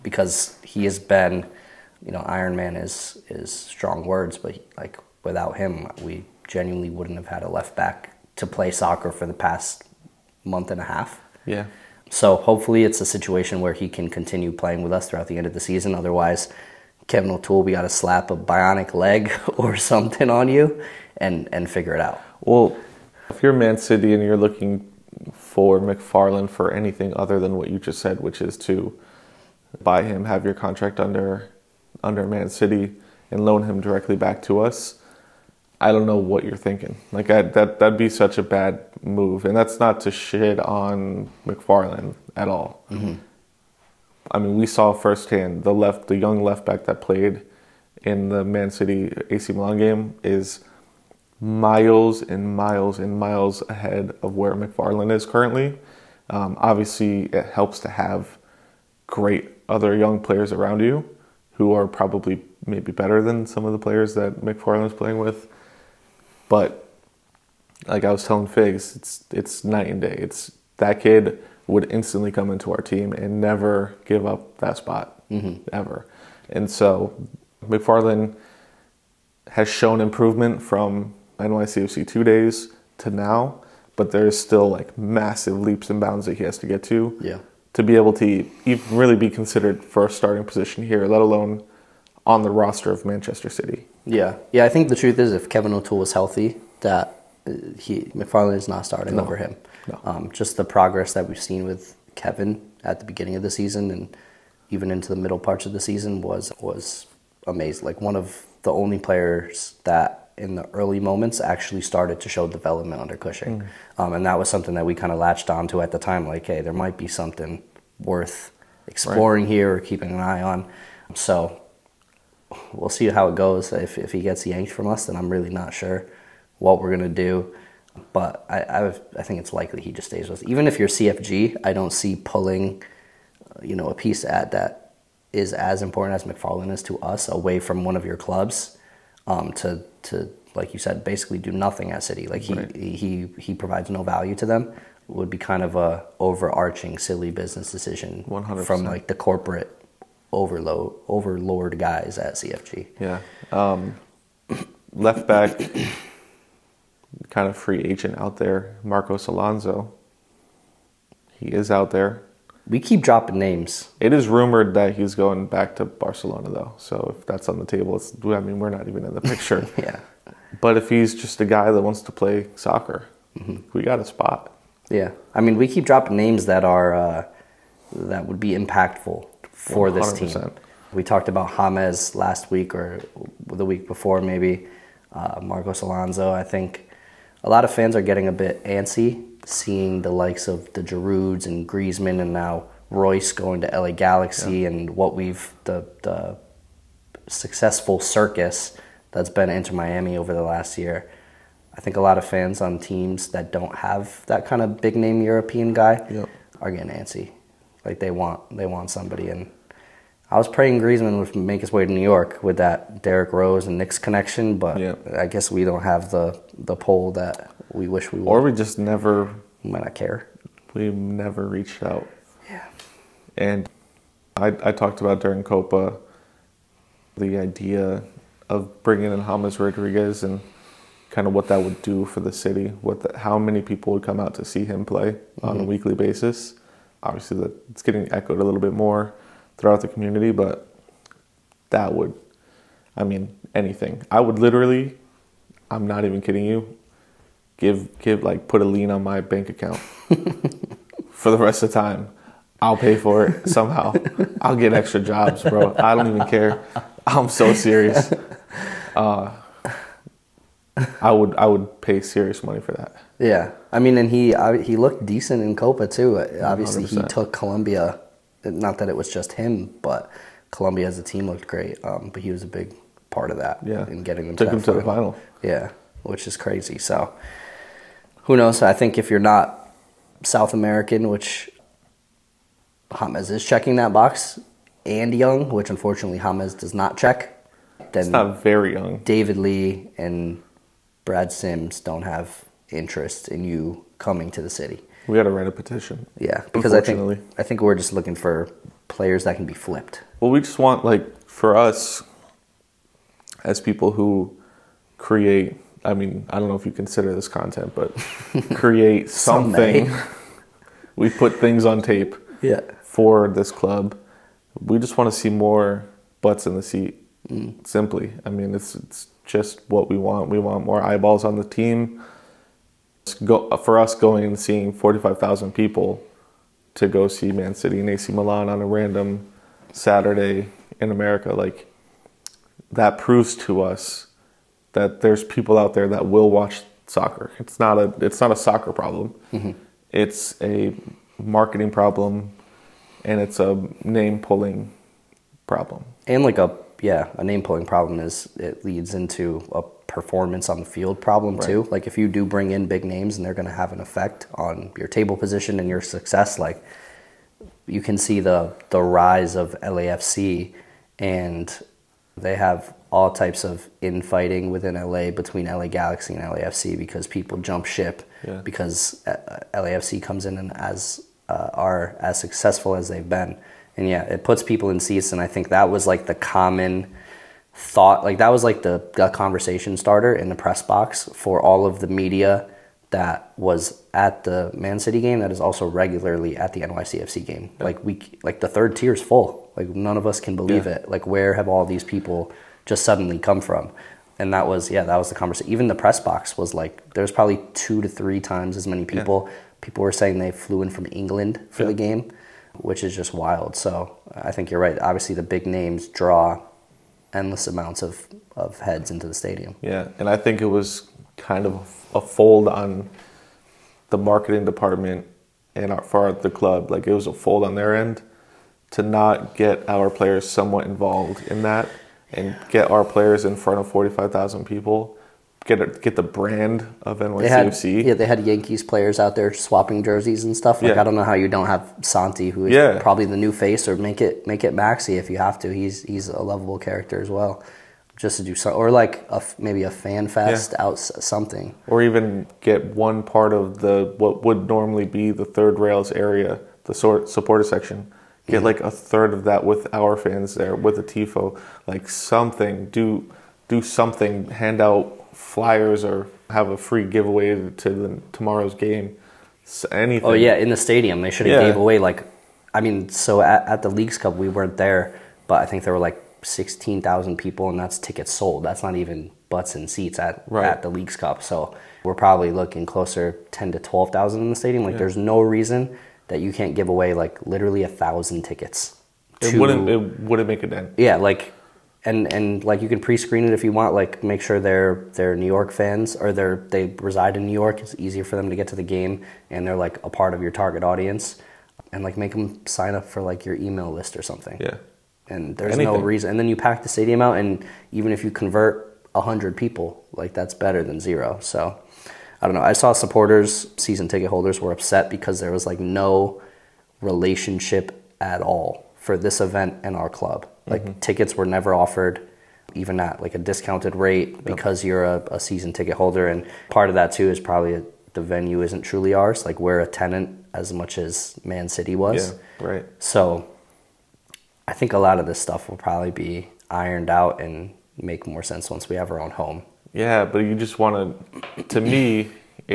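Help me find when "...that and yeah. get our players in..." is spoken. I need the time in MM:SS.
07:01.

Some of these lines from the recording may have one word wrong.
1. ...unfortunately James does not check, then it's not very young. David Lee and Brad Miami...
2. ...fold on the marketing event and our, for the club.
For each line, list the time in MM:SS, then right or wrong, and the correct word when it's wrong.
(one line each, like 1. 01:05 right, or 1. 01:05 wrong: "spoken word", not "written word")
1. 04:45 wrong: "Sims", not "Miami"
2. 06:52 wrong: "department", not "event".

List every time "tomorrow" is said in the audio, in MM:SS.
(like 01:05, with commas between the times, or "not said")
07:38.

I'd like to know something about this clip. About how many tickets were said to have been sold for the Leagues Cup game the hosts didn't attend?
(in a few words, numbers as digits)
16,000.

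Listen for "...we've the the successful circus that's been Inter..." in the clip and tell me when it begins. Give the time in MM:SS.
03:15.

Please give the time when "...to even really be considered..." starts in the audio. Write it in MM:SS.
01:28.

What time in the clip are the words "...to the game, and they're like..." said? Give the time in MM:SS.
08:08.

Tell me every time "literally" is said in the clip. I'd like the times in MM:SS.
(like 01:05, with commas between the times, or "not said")
04:04, 07:57.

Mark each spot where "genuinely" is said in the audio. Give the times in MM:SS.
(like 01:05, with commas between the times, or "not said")
00:06.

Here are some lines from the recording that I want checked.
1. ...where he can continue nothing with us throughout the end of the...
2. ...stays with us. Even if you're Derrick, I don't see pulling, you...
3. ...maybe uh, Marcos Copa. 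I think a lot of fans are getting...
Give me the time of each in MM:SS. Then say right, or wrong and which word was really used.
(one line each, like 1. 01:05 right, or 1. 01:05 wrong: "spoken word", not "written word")
1. 00:13 wrong: "playing", not "nothing"
2. 02:10 wrong: "CFG", not "Derrick"
3. 03:04 wrong: "Alonso", not "Copa".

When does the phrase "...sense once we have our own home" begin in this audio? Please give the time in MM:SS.
08:48.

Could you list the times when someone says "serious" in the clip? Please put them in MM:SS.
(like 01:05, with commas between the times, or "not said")
04:17, 04:22.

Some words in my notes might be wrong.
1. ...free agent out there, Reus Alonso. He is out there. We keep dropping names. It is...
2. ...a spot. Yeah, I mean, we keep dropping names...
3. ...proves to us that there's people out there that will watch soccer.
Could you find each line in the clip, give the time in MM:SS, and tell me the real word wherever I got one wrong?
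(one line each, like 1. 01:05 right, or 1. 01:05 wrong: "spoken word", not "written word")
1. 02:37 wrong: "Marcos", not "Reus"
2. 02:53 right
3. 05:32 right.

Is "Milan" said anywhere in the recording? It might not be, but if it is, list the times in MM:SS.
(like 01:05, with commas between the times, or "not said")
00:49, 05:28.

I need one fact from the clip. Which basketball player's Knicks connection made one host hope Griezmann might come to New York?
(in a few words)
Derrick Rose.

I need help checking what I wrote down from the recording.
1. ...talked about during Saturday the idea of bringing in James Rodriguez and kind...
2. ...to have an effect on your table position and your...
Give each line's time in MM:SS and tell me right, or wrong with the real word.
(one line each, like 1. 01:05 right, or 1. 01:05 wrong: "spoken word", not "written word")
1. 03:44 wrong: "Copa", not "Saturday"
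2. 05:53 right.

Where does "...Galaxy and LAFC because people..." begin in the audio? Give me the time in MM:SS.
06:05.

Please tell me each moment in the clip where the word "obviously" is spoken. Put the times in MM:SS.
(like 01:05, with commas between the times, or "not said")
00:56, 03:57, 04:26, 06:44.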